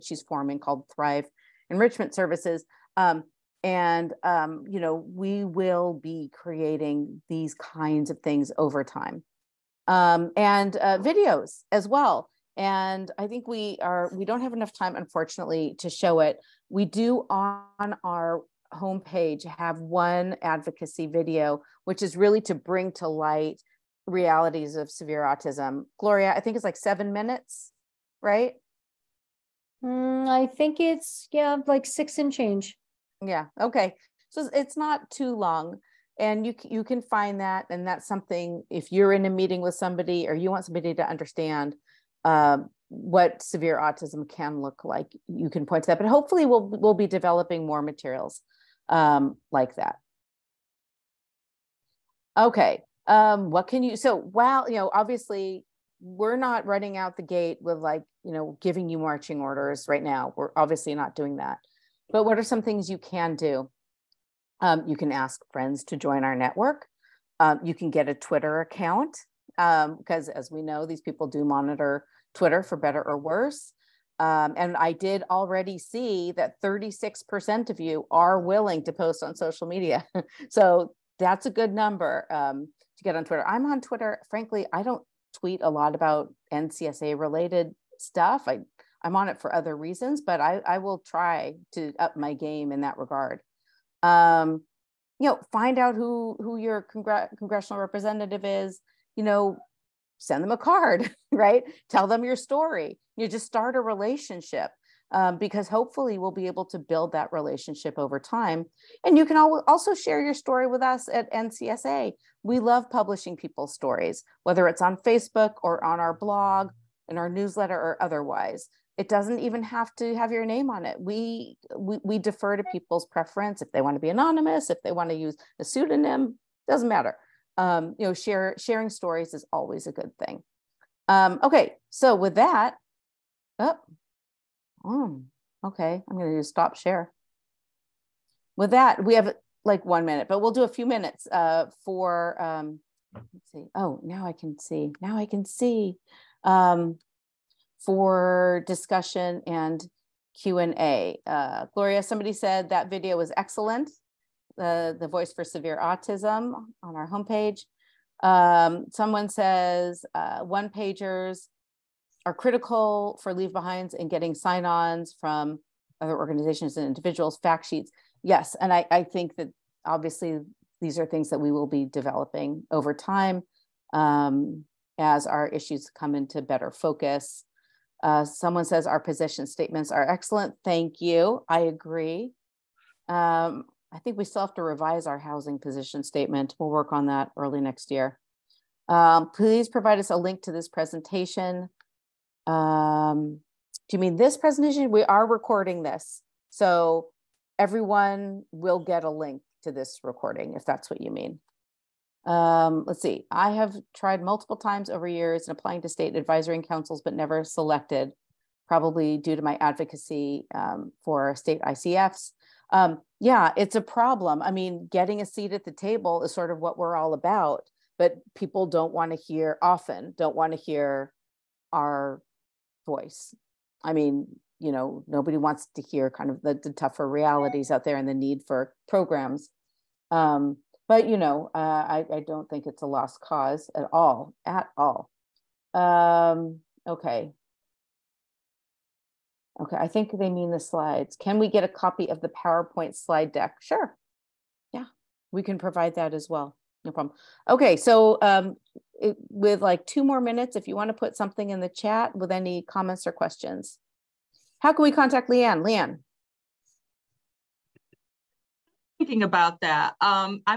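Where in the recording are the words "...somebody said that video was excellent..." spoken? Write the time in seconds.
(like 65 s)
152 s.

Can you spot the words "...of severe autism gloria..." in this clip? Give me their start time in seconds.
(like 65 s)
24 s.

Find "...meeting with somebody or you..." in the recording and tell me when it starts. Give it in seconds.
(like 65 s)
39 s.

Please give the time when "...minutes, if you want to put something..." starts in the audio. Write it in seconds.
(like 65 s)
250 s.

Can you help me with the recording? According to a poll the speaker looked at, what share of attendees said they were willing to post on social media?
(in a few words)
36%.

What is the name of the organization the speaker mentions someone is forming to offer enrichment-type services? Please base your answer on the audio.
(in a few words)
Thrive Enrichment Services.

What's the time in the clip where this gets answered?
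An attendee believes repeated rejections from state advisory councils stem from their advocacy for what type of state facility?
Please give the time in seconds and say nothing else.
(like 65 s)
211 s.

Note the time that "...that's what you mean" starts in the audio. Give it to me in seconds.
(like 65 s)
200 s.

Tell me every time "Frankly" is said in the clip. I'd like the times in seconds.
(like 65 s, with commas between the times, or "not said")
84 s.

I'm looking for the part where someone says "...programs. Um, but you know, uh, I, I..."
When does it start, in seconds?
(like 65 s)
228 s.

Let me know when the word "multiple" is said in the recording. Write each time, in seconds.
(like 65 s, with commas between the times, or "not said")
204 s.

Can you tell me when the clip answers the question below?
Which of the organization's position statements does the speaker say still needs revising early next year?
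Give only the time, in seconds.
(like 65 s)
185 s.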